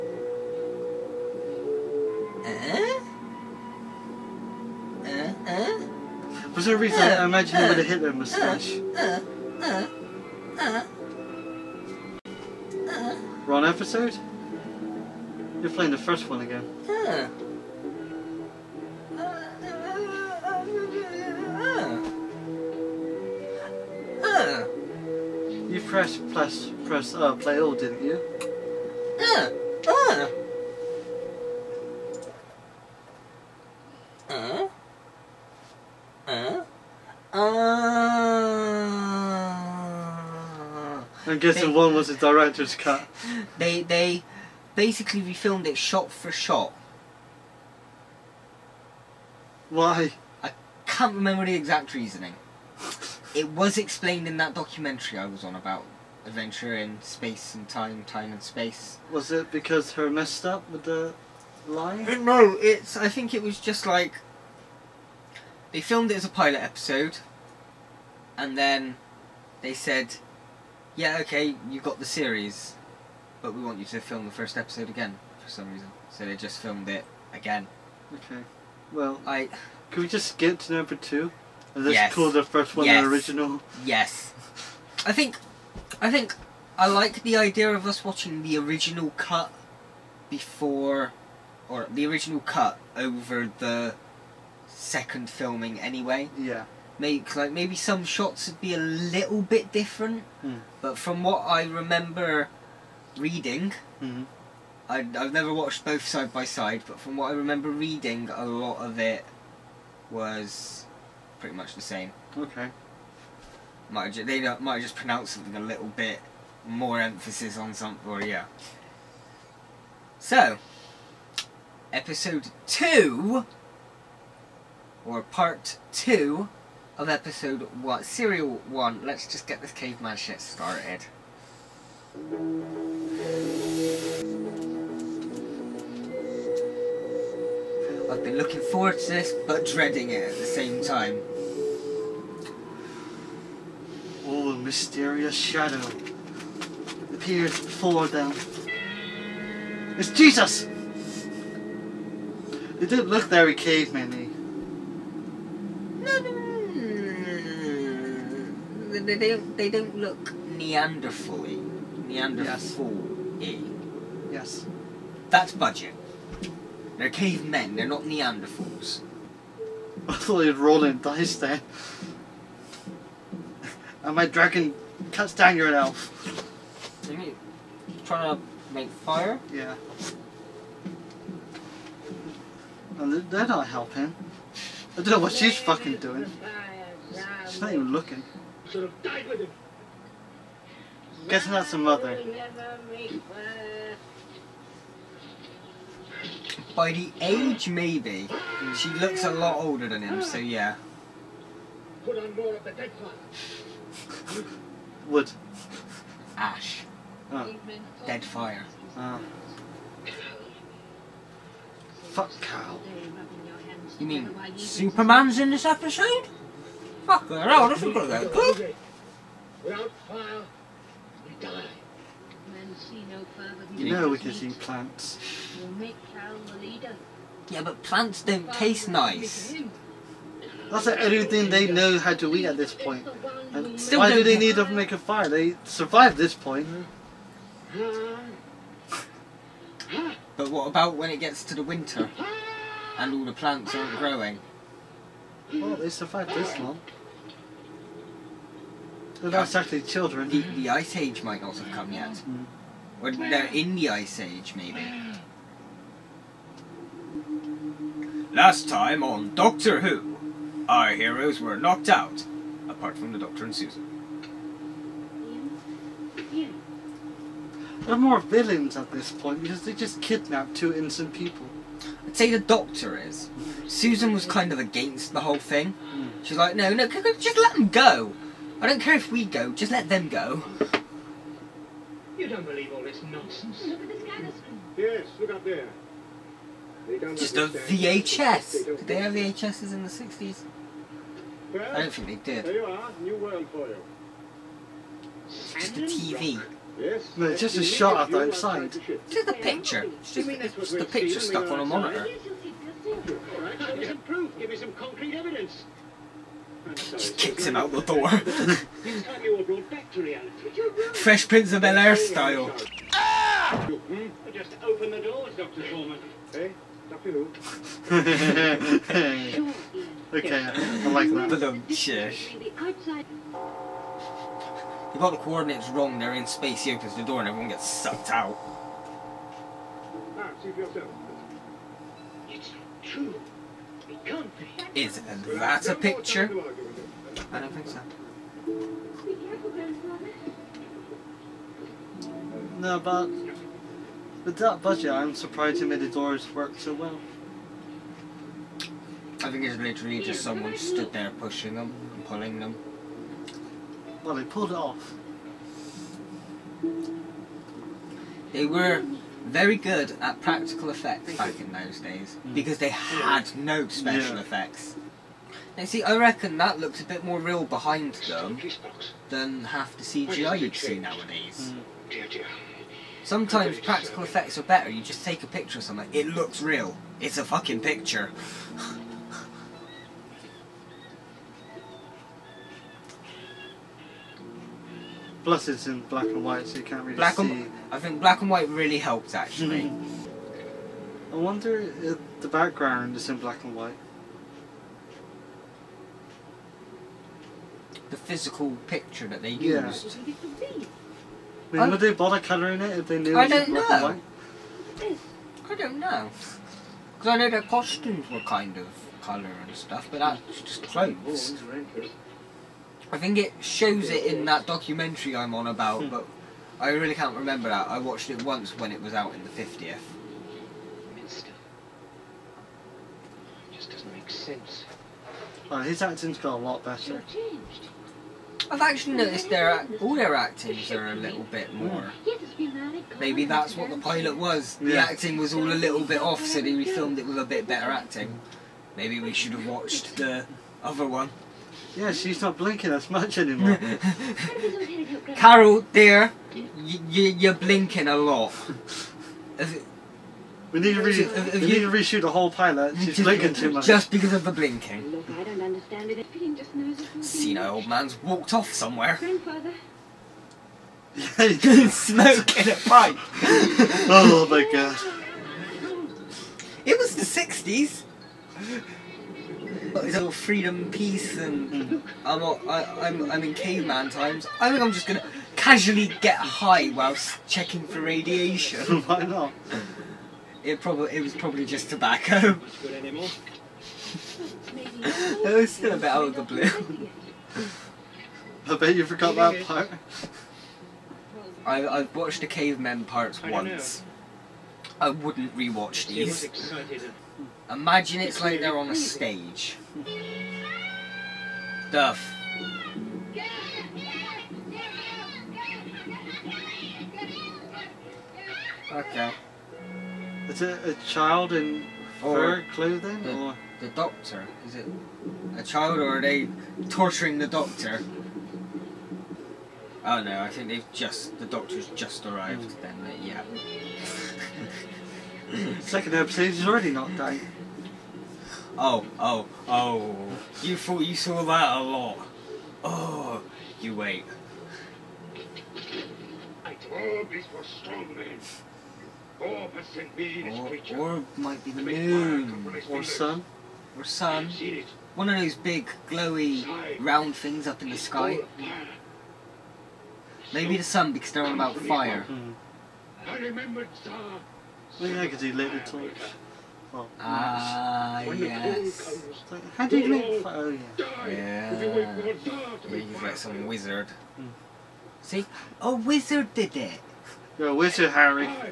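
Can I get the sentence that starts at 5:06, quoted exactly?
Just kicks him out the door.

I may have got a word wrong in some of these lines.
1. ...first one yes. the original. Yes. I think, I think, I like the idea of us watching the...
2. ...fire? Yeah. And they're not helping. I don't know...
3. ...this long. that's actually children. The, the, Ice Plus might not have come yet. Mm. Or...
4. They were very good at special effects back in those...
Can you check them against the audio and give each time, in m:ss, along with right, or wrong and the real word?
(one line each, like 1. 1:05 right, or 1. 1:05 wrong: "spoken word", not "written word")
1. 1:22 right
2. 2:58 right
3. 4:06 wrong: "Age", not "Plus"
4. 5:58 wrong: "practical", not "special".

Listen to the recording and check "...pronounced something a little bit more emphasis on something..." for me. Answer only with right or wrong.
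right.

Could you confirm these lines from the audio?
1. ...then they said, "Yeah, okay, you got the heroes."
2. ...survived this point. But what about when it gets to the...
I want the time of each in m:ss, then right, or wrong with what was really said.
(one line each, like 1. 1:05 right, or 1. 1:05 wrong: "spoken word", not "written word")
1. 1:08 wrong: "series", not "heroes"
2. 3:55 right.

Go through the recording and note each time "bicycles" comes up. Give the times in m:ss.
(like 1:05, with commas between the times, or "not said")
not said.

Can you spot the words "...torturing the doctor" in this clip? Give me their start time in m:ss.
8:36.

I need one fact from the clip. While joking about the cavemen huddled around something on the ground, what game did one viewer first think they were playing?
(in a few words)
Rolling dice.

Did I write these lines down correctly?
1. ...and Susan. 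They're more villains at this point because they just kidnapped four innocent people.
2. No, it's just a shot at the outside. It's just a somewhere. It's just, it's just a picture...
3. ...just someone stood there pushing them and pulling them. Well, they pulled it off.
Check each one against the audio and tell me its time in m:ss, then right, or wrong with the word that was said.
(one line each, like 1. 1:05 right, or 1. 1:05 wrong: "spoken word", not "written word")
1. 4:23 wrong: "two", not "four"
2. 4:57 wrong: "picture", not "somewhere"
3. 5:50 right.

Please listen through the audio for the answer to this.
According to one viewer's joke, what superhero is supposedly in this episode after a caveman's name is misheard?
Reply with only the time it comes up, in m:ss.
3:34.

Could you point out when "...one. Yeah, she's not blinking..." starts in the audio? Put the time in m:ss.
7:20.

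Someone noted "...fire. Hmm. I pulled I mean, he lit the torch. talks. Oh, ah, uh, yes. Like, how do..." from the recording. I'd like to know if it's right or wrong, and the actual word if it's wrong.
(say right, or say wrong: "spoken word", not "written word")
wrong: "remembered", not "pulled".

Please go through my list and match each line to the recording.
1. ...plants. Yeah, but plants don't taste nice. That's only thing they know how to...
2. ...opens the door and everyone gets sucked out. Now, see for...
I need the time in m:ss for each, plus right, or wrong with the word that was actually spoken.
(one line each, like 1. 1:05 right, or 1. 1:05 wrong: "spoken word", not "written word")
1. 3:44 right
2. 5:26 right.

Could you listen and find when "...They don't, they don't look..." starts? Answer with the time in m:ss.
2:39.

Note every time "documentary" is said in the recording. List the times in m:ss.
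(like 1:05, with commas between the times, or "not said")
0:54, 6:54.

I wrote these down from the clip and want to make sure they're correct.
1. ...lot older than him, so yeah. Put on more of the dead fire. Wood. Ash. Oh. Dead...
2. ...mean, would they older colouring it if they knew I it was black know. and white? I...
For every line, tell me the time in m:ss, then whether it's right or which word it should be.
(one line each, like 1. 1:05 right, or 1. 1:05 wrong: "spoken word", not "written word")
1. 3:19 right
2. 6:41 wrong: "bother", not "older".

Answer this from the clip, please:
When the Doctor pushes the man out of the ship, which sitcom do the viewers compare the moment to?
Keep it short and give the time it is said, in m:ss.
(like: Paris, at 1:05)
Fresh Prince of Bel Air, at 5:10.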